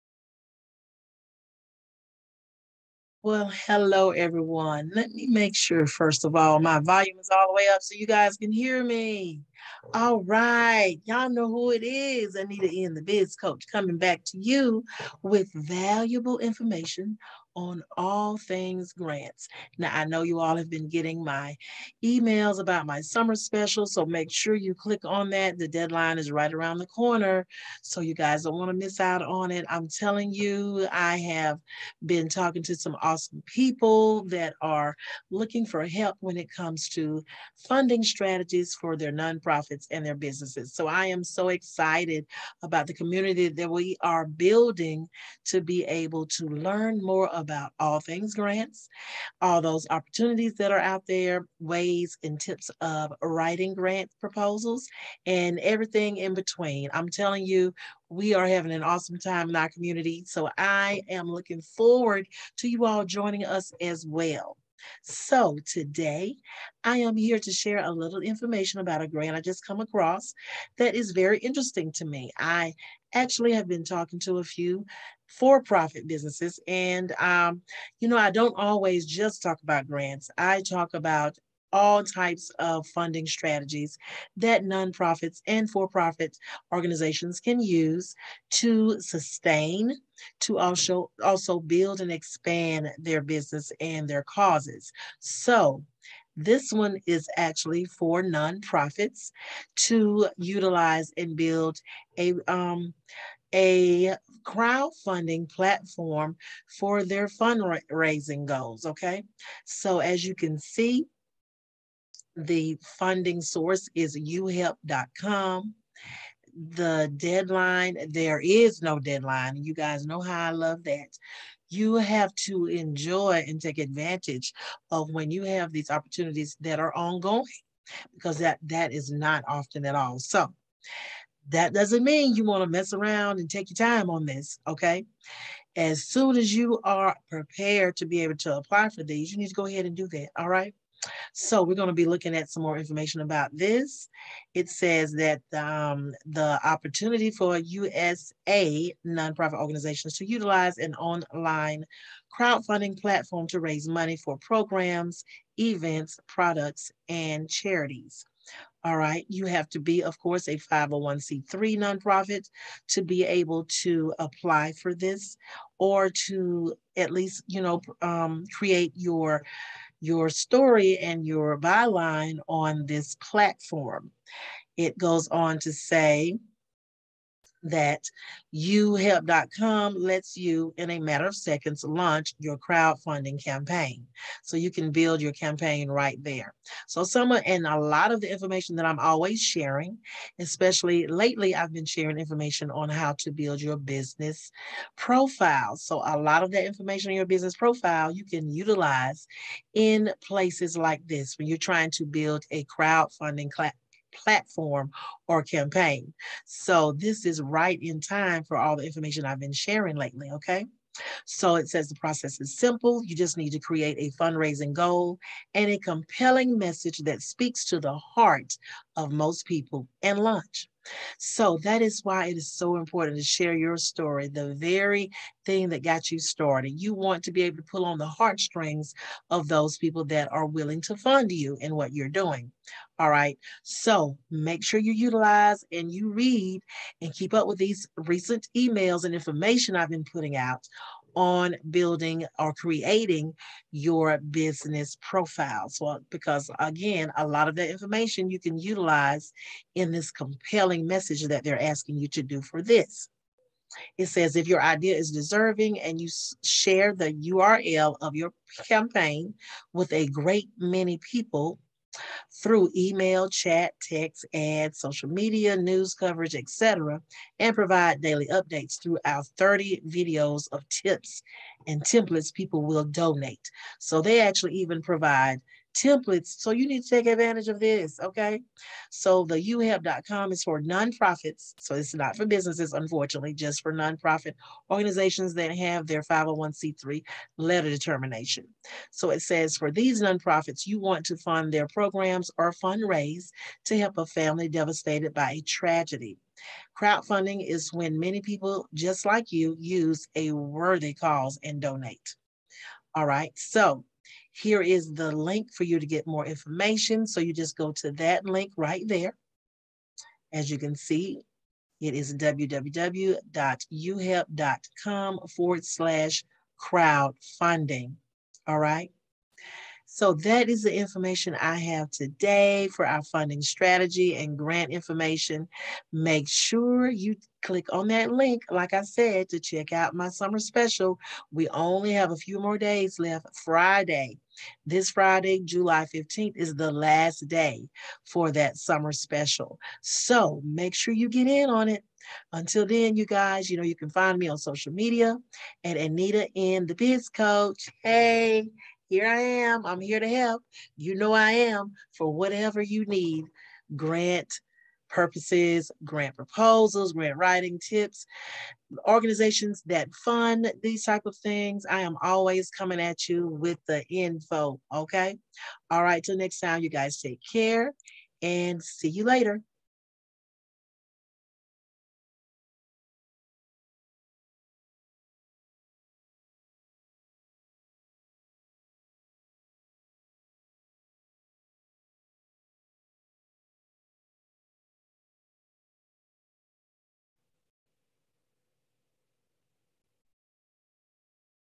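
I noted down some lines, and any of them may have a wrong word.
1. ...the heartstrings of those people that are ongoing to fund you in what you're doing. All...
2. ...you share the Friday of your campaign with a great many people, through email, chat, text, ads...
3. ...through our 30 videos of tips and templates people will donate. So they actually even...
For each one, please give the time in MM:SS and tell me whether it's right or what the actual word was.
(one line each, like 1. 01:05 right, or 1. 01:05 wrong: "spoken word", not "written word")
1. 03:47 wrong: "willing", not "ongoing"
2. 04:15 wrong: "URL", not "Friday"
3. 04:28 right.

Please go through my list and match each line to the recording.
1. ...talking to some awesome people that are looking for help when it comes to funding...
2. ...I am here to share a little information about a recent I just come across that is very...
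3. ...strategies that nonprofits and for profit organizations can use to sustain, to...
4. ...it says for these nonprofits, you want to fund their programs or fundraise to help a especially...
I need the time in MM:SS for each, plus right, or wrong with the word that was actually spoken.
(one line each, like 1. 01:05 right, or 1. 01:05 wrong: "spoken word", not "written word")
1. 00:32 right
2. 01:06 wrong: "grant", not "recent"
3. 01:23 right
4. 04:49 wrong: "family", not "especially".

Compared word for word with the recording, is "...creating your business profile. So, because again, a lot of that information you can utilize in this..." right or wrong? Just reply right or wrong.
right.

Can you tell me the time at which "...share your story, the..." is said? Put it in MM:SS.
03:43.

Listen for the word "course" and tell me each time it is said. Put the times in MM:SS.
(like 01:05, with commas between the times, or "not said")
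02:40.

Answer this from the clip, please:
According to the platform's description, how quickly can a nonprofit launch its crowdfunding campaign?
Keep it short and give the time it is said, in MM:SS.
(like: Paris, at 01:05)
in a matter of seconds, at 03:00.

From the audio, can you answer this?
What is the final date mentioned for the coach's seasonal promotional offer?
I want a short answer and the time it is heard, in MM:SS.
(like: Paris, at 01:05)
July 15th, at 05:35.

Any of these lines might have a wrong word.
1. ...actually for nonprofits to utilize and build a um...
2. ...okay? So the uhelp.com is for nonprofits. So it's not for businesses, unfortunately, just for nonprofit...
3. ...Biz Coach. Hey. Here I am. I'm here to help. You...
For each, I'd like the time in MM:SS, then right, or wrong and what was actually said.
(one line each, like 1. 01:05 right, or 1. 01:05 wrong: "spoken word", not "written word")
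1. 01:37 right
2. 04:37 right
3. 05:46 right.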